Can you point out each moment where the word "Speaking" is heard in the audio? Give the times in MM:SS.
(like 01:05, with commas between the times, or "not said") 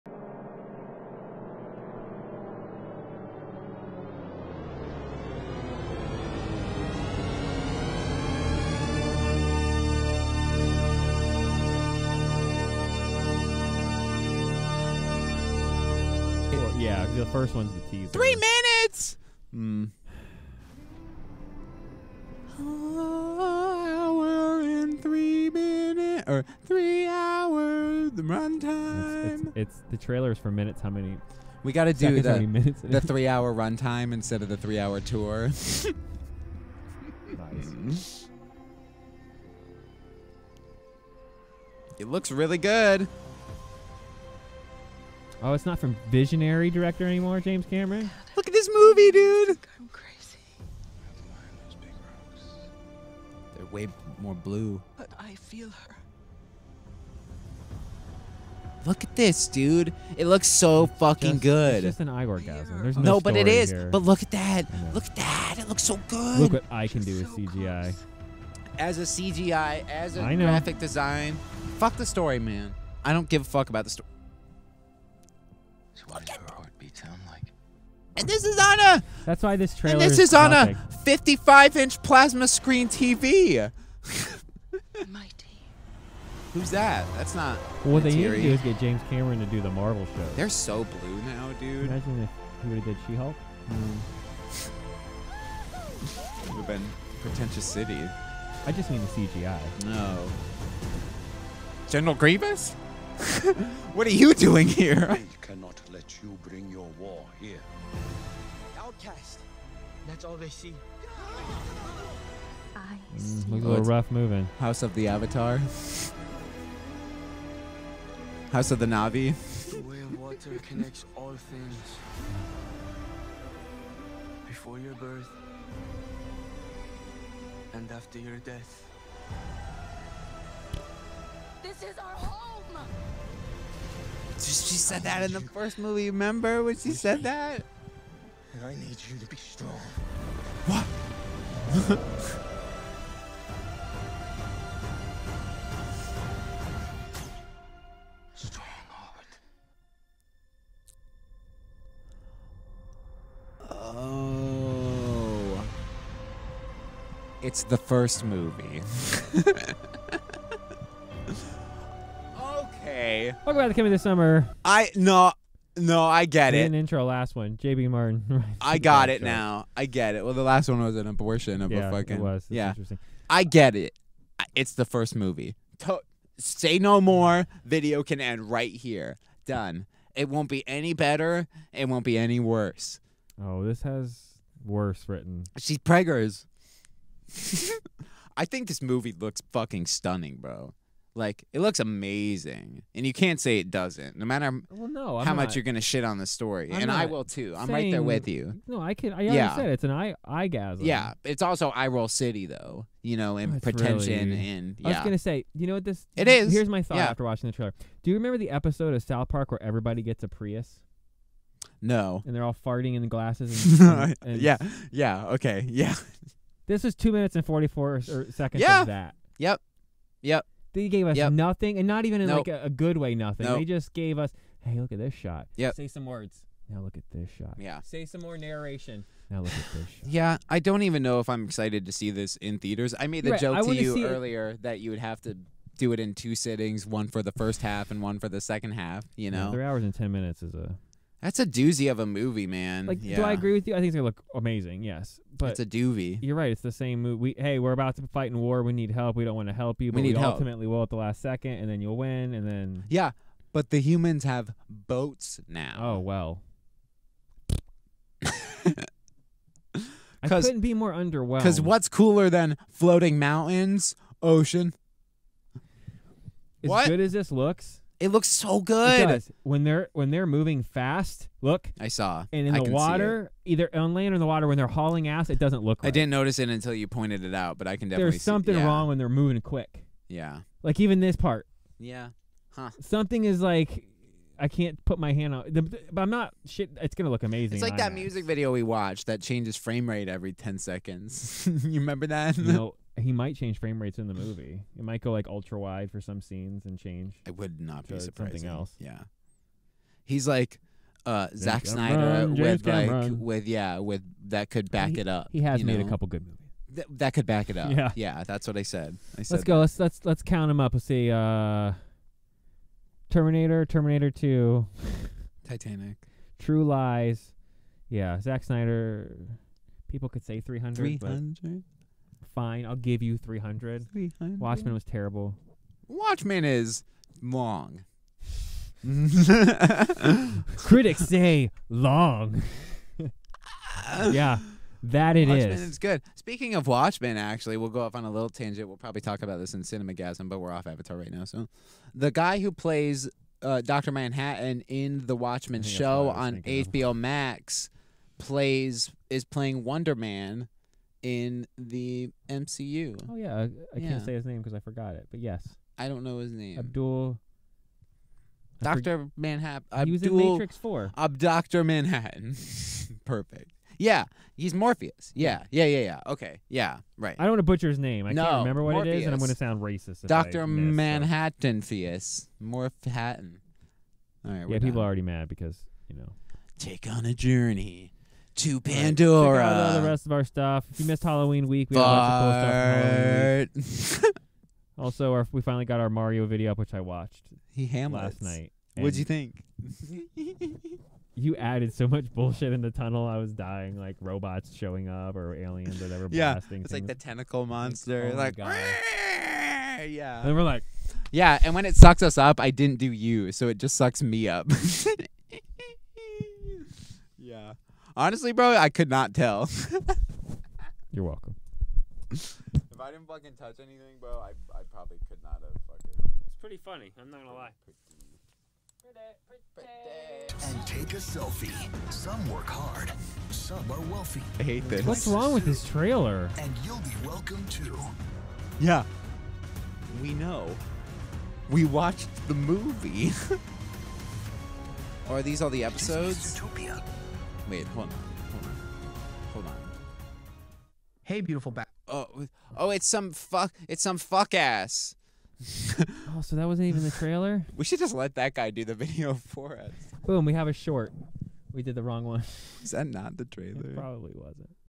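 05:36.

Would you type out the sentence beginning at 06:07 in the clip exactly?
I don't want to butcher his name.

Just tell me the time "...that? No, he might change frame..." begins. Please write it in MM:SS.
04:52.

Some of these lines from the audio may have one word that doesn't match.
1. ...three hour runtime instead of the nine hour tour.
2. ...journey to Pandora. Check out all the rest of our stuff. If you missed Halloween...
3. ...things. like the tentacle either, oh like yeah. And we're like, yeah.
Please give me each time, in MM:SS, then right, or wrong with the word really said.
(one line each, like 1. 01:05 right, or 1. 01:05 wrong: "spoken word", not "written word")
1. 00:32 wrong: "three", not "nine"
2. 06:17 right
3. 06:36 wrong: "monster", not "either".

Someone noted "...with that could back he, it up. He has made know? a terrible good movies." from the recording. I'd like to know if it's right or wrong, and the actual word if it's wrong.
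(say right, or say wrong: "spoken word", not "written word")
wrong: "couple", not "terrible".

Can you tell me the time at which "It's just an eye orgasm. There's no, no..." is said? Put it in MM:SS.
01:01.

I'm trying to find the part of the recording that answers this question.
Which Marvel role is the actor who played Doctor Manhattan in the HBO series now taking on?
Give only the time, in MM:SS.
05:49.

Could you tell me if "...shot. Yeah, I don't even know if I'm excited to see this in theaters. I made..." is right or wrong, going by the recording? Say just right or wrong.
right.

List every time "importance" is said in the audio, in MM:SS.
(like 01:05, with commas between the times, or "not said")
not said.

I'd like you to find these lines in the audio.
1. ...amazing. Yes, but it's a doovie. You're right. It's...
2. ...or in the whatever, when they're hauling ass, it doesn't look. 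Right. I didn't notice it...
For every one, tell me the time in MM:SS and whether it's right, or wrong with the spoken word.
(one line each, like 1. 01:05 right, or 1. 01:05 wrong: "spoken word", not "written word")
1. 04:04 right
2. 04:34 wrong: "water", not "whatever".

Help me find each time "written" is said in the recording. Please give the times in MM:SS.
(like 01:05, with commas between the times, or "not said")
03:05.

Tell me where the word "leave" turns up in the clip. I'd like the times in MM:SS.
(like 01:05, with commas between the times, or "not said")
not said.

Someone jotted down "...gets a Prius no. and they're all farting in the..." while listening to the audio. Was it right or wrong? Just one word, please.
right.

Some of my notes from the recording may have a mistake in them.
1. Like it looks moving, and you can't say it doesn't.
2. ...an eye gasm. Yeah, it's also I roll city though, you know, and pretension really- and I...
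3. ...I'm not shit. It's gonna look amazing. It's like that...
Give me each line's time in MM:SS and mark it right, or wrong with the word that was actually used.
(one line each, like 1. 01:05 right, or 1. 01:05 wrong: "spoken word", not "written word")
1. 03:11 wrong: "amazing", not "moving"
2. 03:19 right
3. 04:46 right.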